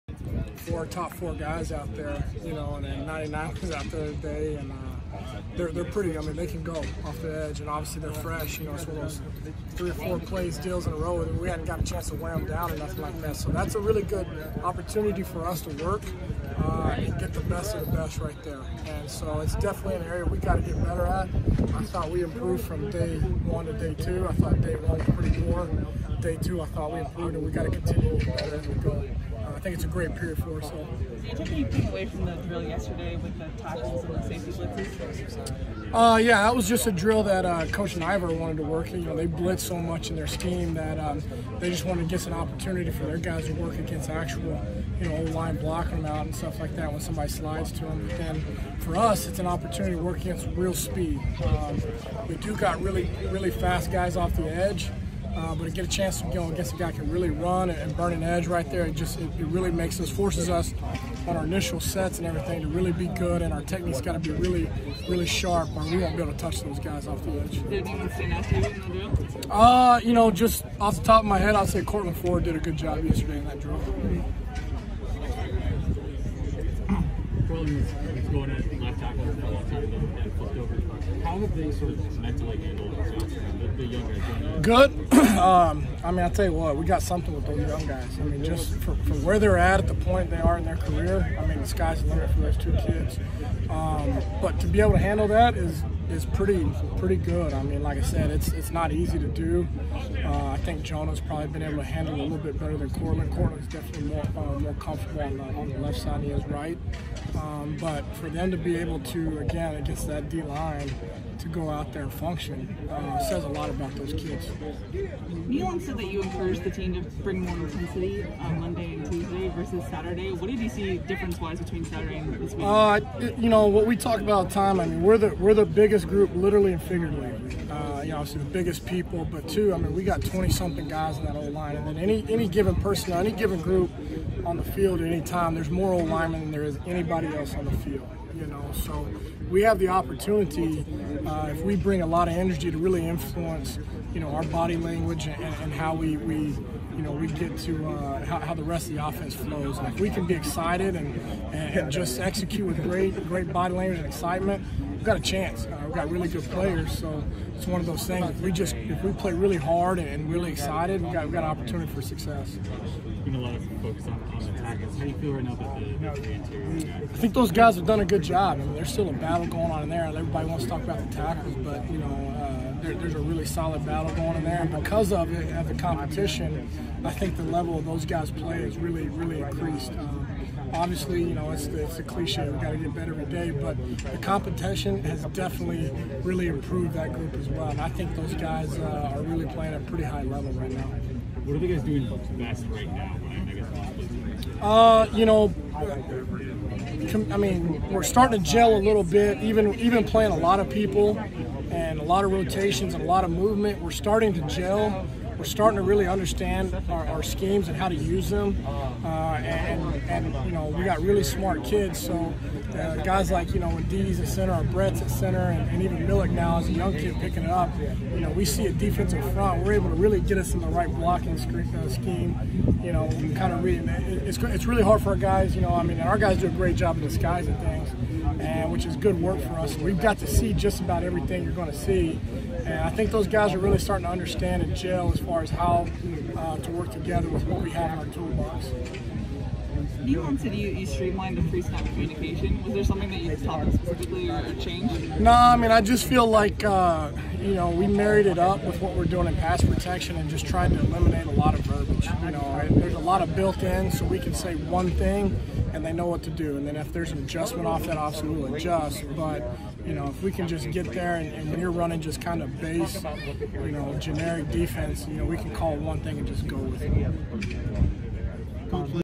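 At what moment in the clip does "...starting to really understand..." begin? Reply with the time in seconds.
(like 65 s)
205 s.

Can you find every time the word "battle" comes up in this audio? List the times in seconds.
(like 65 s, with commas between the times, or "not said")
169 s, 173 s.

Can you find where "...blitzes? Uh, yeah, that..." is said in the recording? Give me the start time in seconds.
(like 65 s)
34 s.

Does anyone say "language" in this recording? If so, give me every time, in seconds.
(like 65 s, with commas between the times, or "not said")
144 s, 153 s.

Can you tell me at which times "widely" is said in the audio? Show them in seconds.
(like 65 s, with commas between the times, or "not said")
not said.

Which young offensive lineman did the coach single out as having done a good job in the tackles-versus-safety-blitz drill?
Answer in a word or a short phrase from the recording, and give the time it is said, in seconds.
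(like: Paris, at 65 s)
Courtland Ford, at 71 s.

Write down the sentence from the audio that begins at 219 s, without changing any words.
We're able to really get us in the right blocking uh, scheme, you know, and kind of read it.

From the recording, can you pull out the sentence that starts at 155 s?
Uh, we've got really good players, so it's one of those things.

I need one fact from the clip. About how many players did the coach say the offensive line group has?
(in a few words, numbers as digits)
20-something.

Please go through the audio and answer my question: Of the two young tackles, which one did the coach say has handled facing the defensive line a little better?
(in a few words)
Jonah.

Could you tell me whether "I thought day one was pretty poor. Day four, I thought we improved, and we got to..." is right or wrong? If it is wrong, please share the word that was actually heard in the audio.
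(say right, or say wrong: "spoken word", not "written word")
wrong: "two", not "four".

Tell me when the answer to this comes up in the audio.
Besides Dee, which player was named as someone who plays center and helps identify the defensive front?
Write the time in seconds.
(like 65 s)
214 s.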